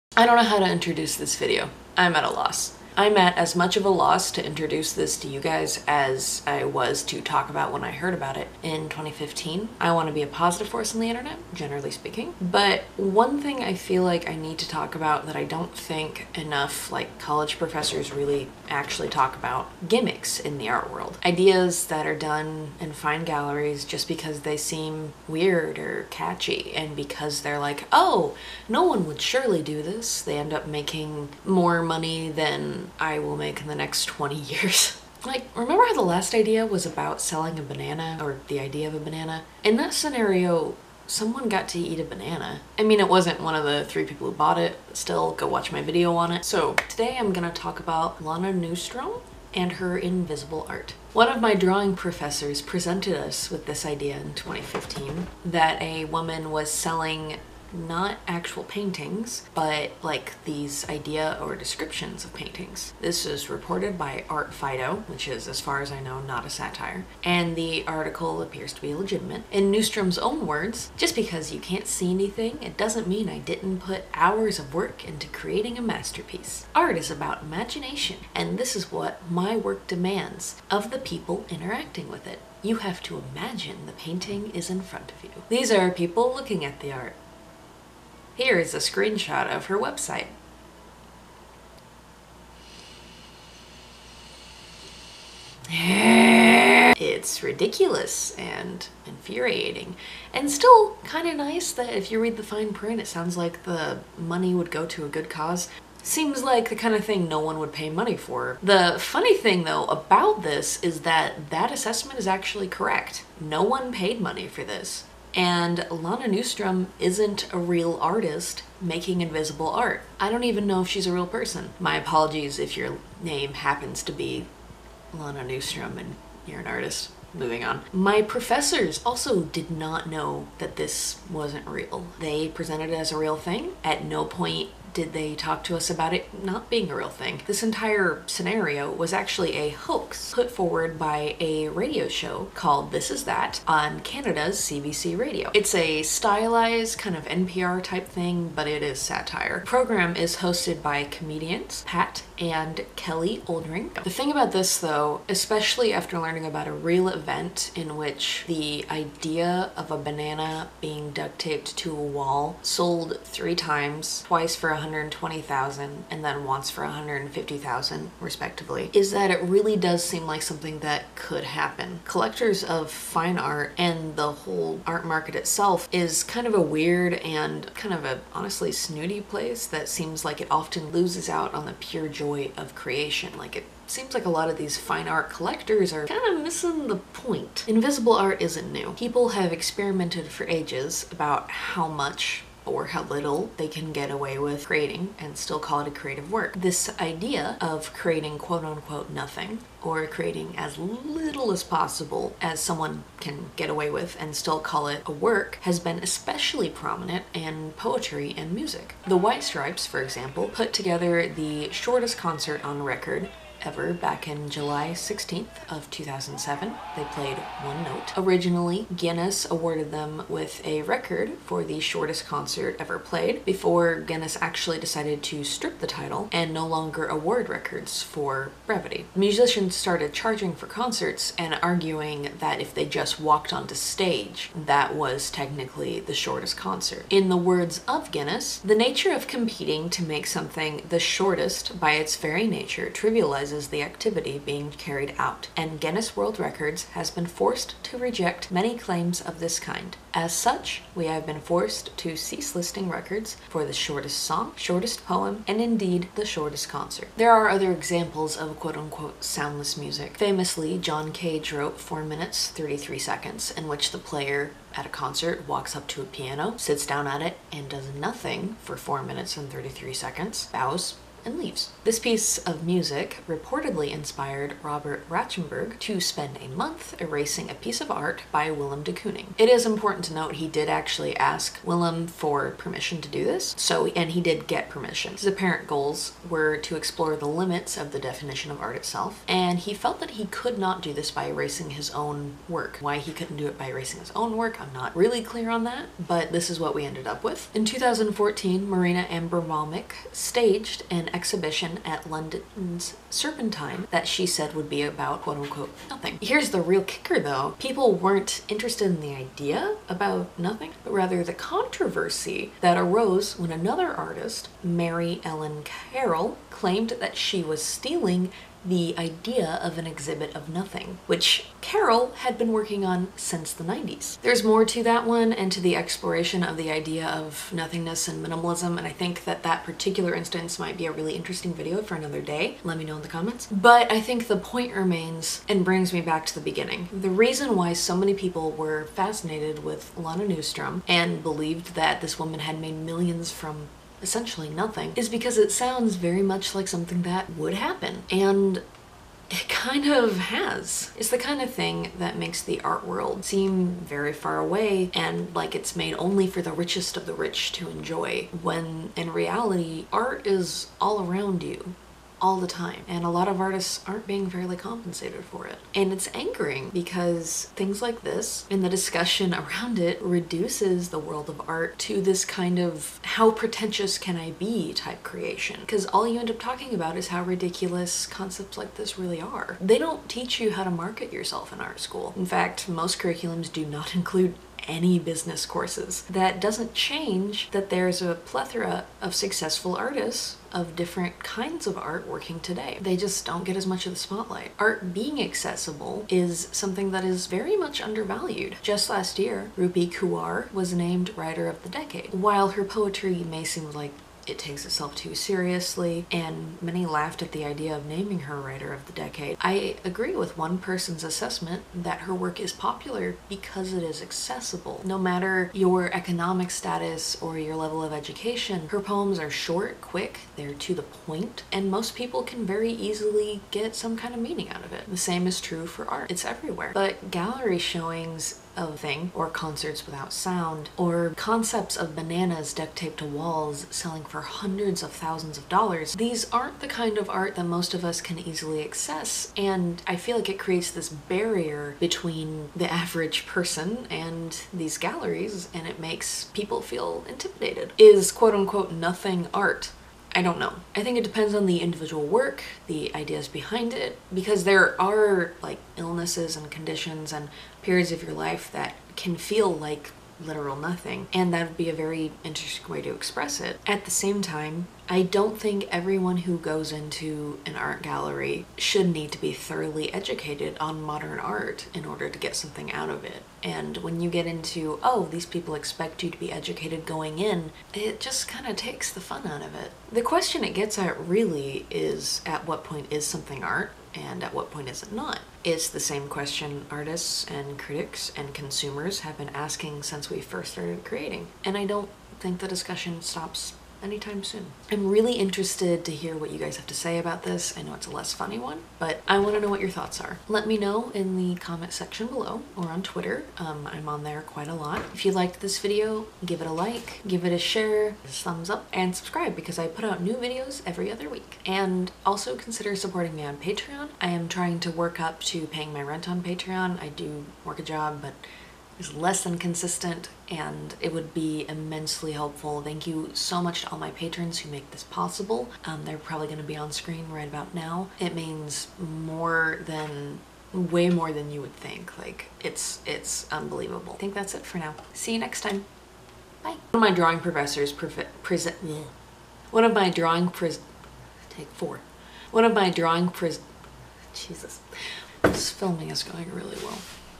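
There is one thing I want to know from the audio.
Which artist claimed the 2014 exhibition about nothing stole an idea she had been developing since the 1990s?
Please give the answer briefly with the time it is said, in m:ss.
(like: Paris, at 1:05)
Mary Ellen Carroll, at 5:14.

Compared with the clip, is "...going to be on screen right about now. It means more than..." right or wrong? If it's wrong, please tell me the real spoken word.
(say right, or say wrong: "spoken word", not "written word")
right.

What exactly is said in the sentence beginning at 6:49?
I agree with one person's assessment that her work is popular because it is accessible.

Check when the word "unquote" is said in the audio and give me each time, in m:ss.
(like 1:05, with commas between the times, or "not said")
3:18, 4:18, 5:05, 7:28.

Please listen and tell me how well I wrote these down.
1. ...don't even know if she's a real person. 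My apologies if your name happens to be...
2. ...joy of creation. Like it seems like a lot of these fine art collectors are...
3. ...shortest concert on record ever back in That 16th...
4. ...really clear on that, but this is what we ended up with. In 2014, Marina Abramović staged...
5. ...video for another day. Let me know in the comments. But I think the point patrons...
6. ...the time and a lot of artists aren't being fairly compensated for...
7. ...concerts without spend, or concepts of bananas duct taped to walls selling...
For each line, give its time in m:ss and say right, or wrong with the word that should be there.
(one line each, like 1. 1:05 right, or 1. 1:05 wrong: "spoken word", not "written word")
1. 2:00 right
2. 3:02 right
3. 3:31 wrong: "July", not "That"
4. 4:54 right
5. 5:31 wrong: "remains", not "patrons"
6. 6:02 right
7. 7:09 wrong: "sound", not "spend".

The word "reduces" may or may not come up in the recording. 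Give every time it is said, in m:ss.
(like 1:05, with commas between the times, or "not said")
6:10.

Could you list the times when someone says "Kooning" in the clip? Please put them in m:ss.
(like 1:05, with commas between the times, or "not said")
4:38.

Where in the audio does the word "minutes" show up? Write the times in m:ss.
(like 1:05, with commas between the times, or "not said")
4:22, 4:29.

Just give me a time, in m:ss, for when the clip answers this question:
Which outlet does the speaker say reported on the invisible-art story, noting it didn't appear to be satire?
1:04.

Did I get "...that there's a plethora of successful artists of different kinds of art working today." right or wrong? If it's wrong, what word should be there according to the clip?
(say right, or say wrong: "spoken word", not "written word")
right.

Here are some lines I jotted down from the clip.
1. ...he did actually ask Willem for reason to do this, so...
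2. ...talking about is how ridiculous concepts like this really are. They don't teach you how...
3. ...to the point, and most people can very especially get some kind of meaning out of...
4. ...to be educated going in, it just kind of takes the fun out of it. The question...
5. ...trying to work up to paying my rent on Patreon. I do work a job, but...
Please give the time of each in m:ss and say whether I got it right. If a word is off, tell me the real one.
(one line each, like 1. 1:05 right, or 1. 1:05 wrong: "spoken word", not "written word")
1. 4:40 wrong: "permission", not "reason"
2. 6:16 right
3. 7:00 wrong: "easily", not "especially"
4. 7:56 right
5. 8:34 right.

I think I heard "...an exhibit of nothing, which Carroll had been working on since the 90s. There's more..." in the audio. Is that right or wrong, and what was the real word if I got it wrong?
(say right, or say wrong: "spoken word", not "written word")
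right.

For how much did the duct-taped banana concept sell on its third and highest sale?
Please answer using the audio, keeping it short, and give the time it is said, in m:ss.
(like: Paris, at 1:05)
150,000, at 2:46.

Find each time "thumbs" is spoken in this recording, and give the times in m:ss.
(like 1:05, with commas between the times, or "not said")
8:28.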